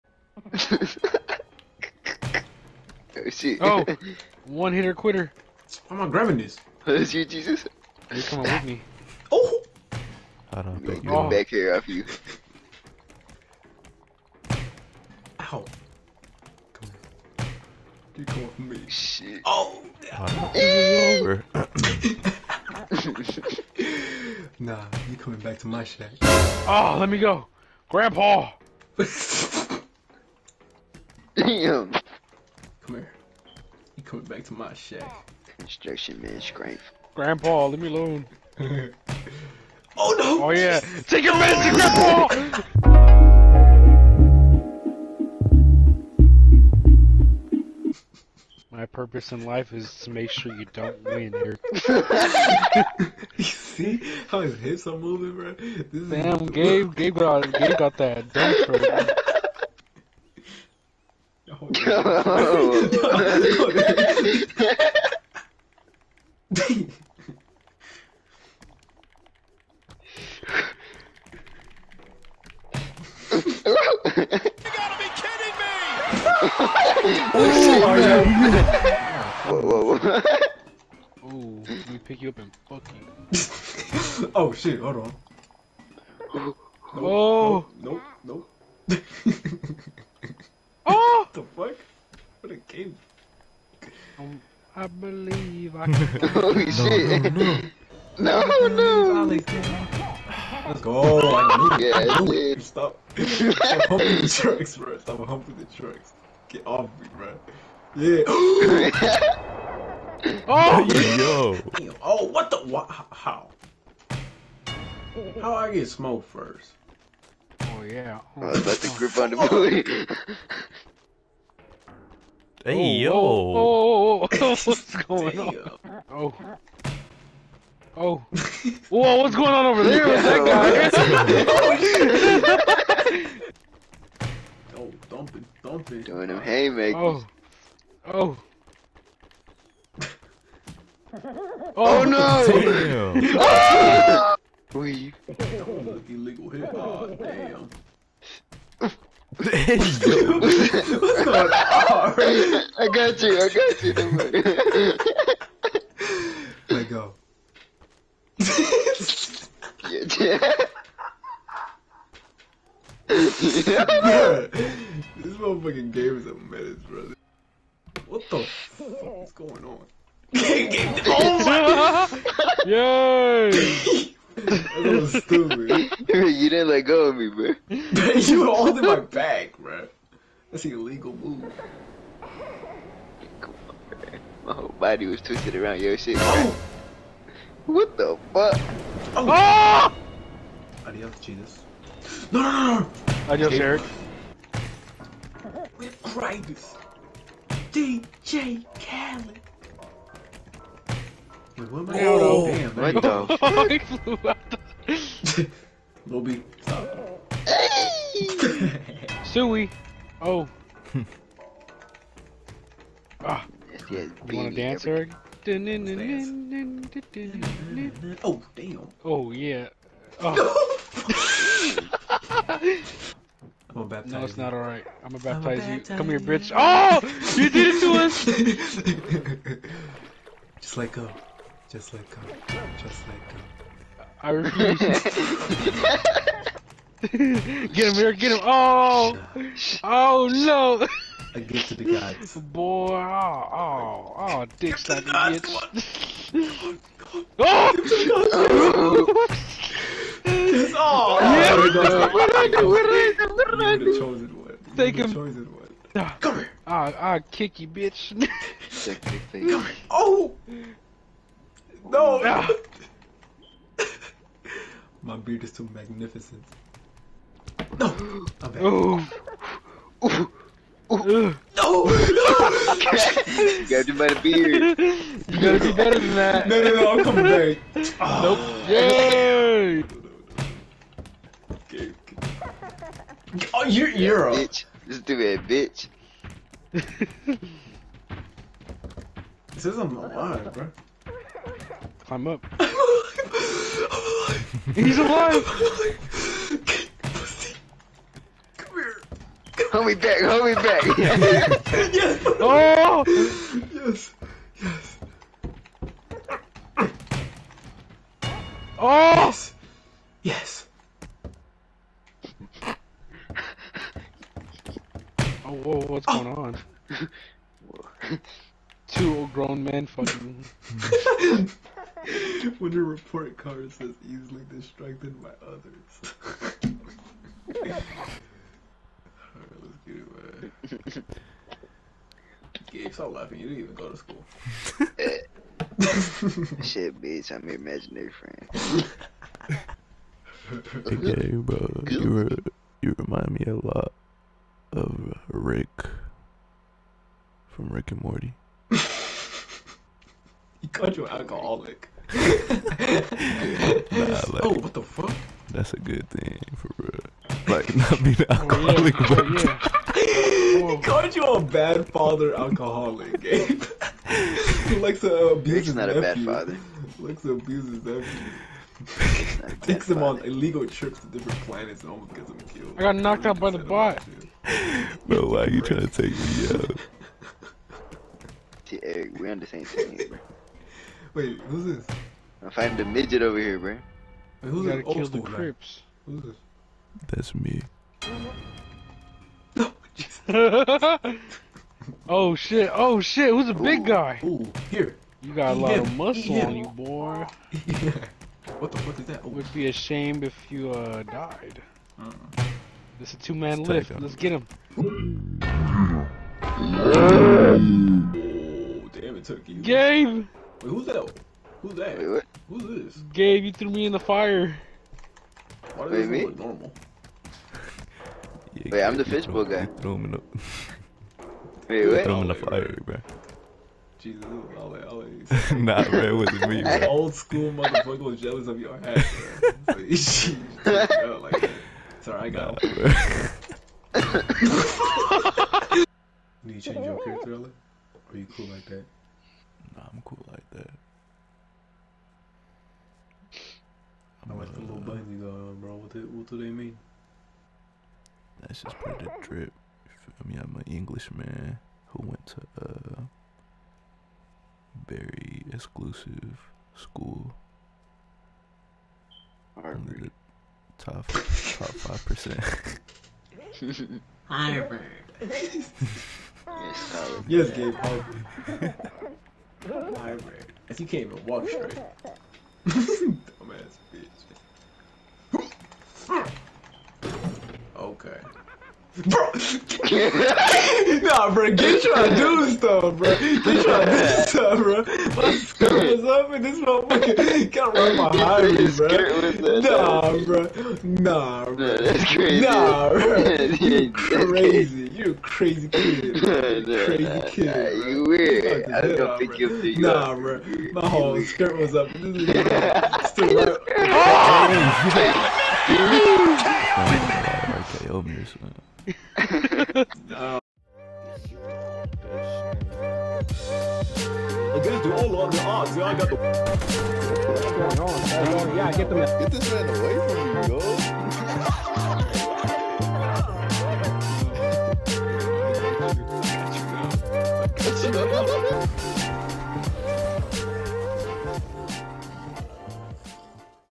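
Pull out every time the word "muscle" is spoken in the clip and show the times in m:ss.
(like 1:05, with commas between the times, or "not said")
6:35.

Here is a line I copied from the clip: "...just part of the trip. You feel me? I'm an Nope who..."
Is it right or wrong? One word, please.
wrong.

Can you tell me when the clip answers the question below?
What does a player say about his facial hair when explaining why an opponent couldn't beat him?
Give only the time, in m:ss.
4:25.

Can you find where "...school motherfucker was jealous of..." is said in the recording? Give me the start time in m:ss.
7:07.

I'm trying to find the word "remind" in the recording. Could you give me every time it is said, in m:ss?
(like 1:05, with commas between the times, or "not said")
5:42.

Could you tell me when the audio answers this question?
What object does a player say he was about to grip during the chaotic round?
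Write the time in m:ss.
1:59.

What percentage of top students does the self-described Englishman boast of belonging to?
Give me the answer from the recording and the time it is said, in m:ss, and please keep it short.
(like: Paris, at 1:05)
5 percent, at 7:41.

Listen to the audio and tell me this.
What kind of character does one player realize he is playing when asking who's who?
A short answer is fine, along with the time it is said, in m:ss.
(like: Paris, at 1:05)
fishbowl guy, at 6:59.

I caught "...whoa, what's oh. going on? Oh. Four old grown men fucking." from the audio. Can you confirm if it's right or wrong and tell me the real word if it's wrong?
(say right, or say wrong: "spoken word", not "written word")
wrong: "Two", not "Four".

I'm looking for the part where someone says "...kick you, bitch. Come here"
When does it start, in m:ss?
4:17.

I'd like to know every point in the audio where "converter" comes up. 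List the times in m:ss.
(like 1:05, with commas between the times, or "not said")
not said.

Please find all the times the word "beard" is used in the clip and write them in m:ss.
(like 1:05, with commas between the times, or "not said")
4:25, 4:34.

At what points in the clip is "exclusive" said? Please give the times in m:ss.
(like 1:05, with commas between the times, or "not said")
7:35.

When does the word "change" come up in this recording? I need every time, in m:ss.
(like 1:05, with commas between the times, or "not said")
7:16.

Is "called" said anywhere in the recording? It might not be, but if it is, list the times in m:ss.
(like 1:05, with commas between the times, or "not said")
5:50, 6:00.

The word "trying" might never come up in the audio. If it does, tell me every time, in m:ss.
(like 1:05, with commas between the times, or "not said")
6:15.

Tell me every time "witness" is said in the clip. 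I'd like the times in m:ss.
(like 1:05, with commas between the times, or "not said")
not said.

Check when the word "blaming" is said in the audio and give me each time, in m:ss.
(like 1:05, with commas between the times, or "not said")
not said.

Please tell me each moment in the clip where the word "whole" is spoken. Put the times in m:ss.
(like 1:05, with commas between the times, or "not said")
3:04, 8:20.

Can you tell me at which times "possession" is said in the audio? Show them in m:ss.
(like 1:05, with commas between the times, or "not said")
not said.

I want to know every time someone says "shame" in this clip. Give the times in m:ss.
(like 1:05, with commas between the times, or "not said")
6:39.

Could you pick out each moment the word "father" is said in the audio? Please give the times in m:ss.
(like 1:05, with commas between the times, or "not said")
6:01, 6:06.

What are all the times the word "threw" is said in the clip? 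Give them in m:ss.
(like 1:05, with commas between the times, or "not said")
6:53, 6:59.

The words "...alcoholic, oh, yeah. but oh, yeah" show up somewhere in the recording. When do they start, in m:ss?
5:58.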